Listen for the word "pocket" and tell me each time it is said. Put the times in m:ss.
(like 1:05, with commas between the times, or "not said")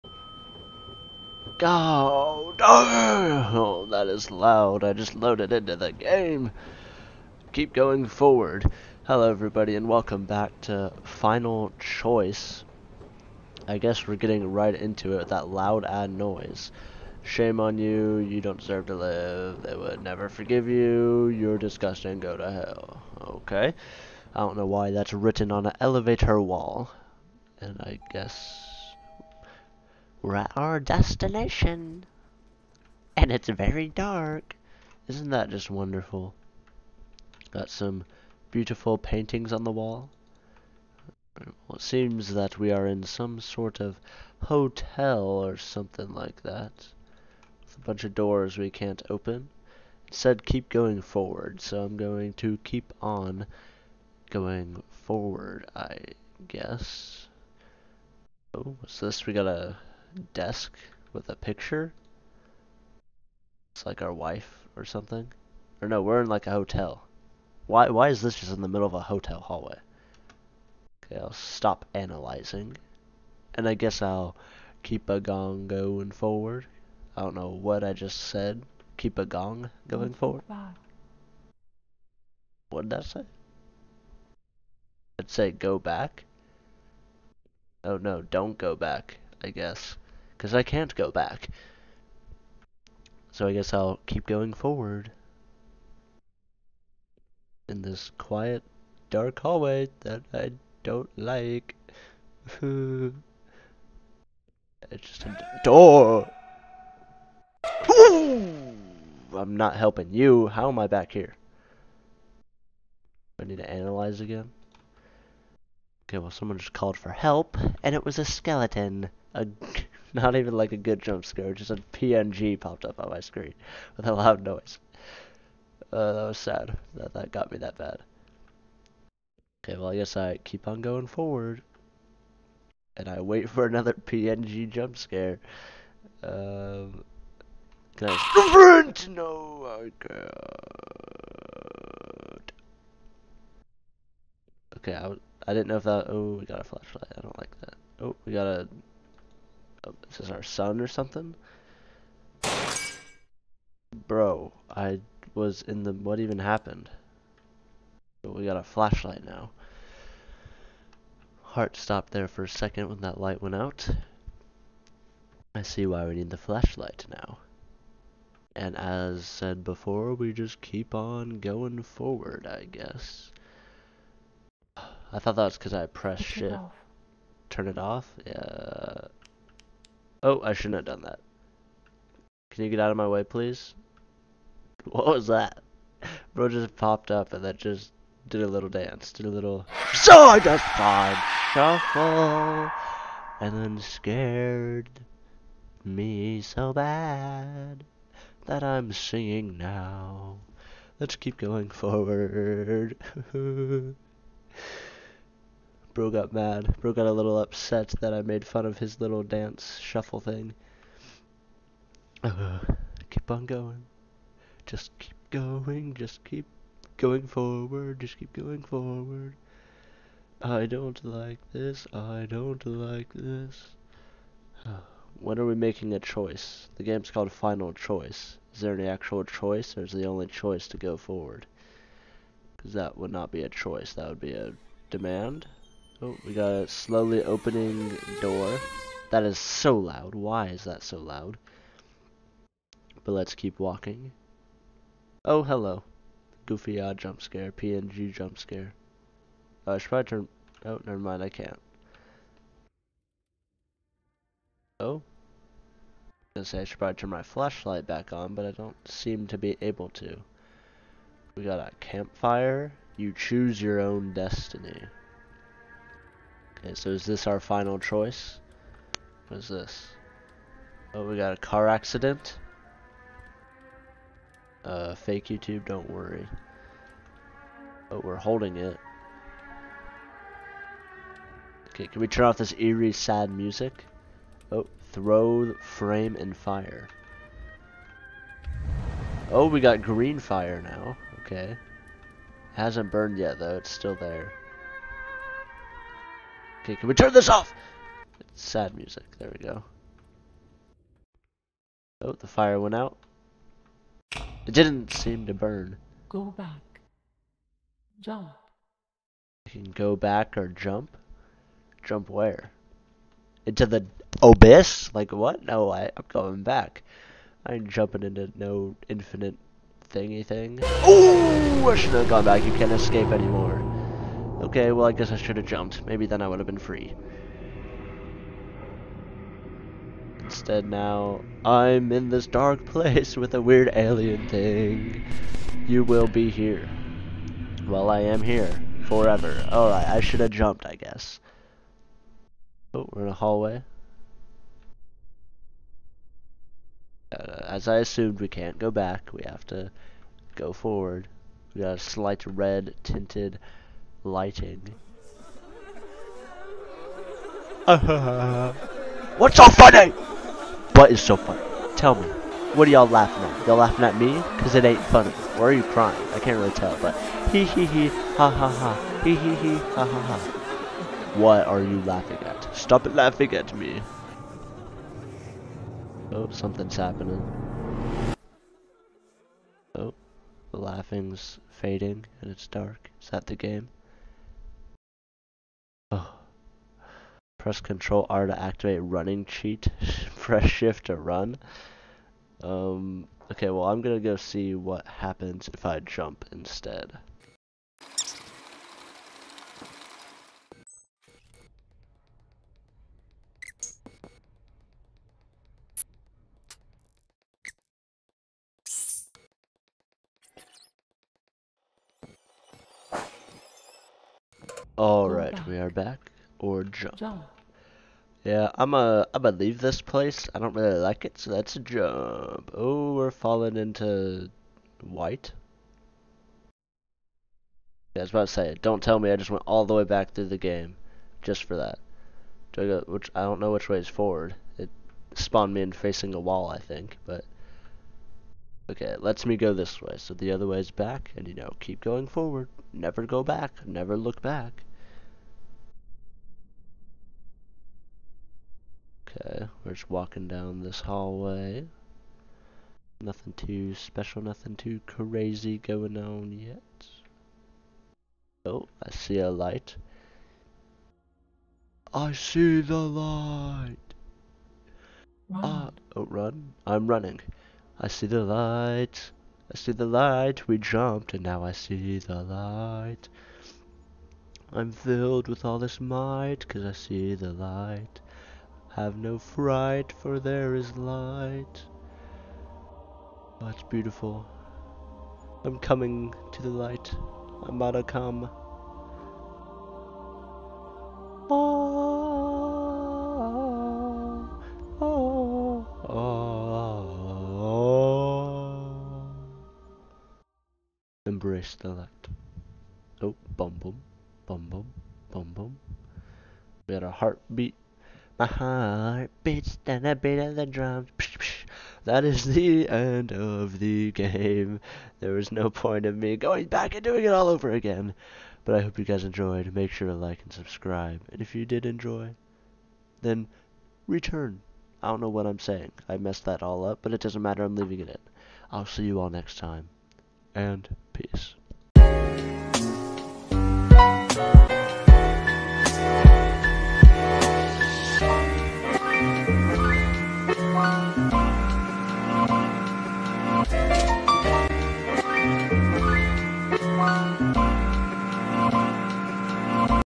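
not said.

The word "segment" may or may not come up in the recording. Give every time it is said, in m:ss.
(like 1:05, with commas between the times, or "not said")
not said.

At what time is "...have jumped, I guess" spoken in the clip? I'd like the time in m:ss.
5:40.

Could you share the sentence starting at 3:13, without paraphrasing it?
And then scared me so bad that I'm singing now.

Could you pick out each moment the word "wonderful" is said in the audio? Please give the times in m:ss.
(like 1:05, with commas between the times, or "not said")
0:35.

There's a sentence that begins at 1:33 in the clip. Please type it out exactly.
So I guess I'll keep going forward in this quiet, dark hallway that I don't like.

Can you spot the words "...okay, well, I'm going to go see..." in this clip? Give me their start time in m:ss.
6:33.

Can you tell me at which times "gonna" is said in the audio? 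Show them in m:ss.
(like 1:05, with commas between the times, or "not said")
4:16, 6:59.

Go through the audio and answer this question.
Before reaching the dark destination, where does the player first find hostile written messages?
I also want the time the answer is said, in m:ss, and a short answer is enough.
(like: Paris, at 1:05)
elevator wall, at 0:25.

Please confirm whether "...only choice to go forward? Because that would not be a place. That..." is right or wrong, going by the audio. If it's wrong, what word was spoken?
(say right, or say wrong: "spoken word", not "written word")
wrong: "choice", not "place".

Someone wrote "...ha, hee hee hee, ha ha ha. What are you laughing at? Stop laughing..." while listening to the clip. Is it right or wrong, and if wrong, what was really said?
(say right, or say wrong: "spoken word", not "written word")
right.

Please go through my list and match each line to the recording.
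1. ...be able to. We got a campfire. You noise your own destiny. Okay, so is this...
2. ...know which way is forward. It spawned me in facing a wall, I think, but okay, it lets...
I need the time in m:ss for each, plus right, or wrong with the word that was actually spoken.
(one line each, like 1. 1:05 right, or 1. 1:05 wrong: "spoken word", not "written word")
1. 4:19 wrong: "choose", not "noise"
2. 7:13 right.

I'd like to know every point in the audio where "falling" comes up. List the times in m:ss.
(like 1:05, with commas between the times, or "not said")
7:03.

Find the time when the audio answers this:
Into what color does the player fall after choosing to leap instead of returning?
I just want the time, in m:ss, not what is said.
7:04.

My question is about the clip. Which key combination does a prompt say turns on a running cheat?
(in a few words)
Control R.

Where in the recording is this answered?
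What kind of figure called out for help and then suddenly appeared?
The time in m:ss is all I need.
1:58.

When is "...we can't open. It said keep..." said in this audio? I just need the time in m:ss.
0:48.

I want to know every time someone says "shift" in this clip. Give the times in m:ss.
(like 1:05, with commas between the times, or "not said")
2:56, 6:30.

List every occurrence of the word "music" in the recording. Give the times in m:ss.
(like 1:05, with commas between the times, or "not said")
4:43, 4:58.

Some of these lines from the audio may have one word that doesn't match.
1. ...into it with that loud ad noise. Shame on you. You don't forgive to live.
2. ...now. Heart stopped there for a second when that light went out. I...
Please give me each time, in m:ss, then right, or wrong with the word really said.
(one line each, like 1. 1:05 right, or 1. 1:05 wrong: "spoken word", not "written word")
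1. 0:14 wrong: "deserve", not "forgive"
2. 2:39 right.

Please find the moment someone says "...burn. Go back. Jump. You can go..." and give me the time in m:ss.
5:05.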